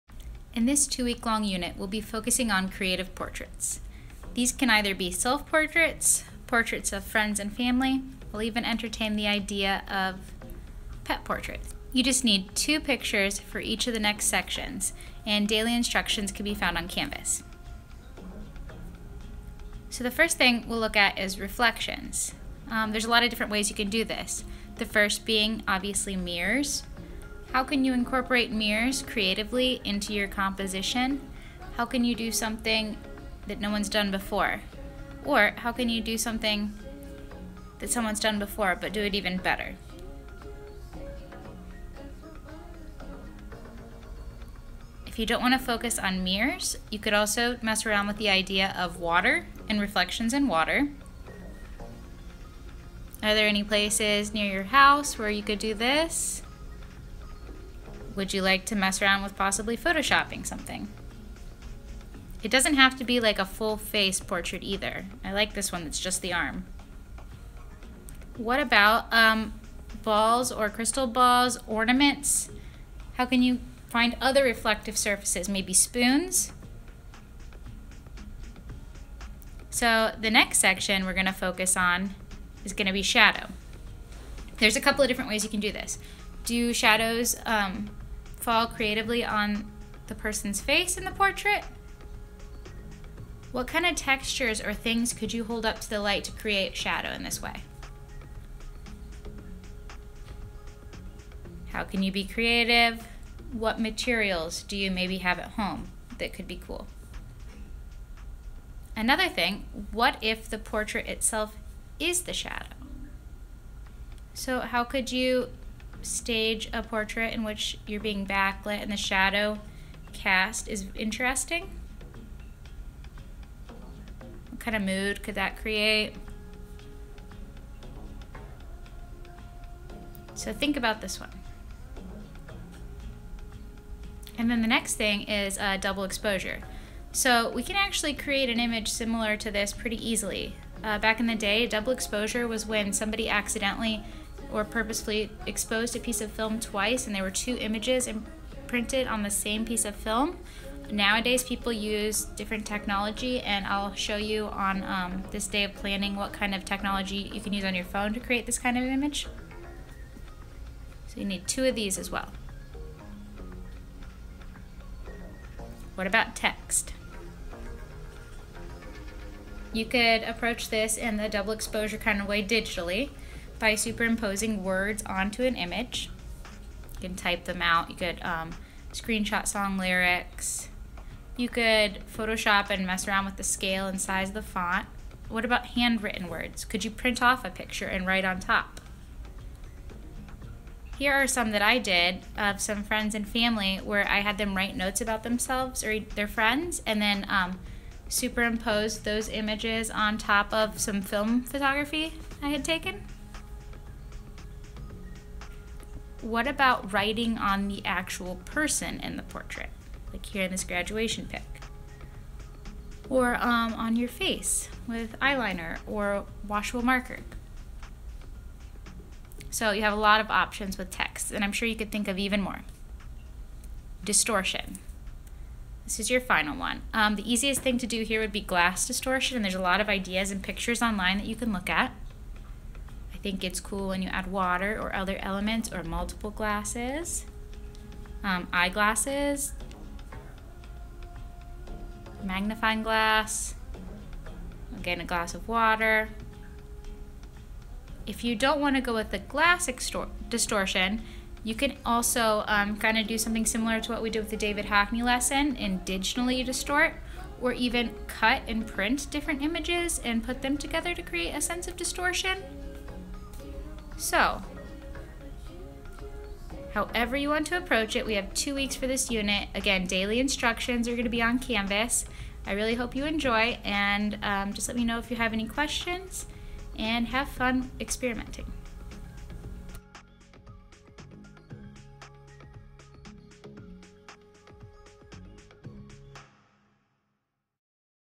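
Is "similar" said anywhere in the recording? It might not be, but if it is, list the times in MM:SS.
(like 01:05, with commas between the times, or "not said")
02:18, 04:13.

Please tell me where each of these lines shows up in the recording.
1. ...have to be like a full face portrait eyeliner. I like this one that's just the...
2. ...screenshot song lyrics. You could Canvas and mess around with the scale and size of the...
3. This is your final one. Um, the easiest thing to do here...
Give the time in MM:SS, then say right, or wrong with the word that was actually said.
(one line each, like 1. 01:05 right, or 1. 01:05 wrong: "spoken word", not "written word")
1. 01:02 wrong: "either", not "eyeliner"
2. 02:58 wrong: "Photoshop", not "Canvas"
3. 03:45 right.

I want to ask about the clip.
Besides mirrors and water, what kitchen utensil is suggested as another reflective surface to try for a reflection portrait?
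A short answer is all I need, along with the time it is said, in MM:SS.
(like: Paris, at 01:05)
Spoons, at 01:15.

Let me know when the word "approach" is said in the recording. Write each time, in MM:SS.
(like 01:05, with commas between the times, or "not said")
02:50, 04:27.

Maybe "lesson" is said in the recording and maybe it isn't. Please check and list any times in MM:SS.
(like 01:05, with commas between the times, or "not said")
04:15.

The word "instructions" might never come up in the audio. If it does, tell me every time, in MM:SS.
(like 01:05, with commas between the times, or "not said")
00:15, 04:30.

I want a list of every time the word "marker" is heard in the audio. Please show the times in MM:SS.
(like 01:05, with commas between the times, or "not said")
03:36.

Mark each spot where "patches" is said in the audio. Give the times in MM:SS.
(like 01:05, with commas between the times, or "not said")
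not said.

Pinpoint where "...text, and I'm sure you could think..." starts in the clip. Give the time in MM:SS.
03:40.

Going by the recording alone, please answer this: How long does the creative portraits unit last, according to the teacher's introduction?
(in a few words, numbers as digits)
2 weeks.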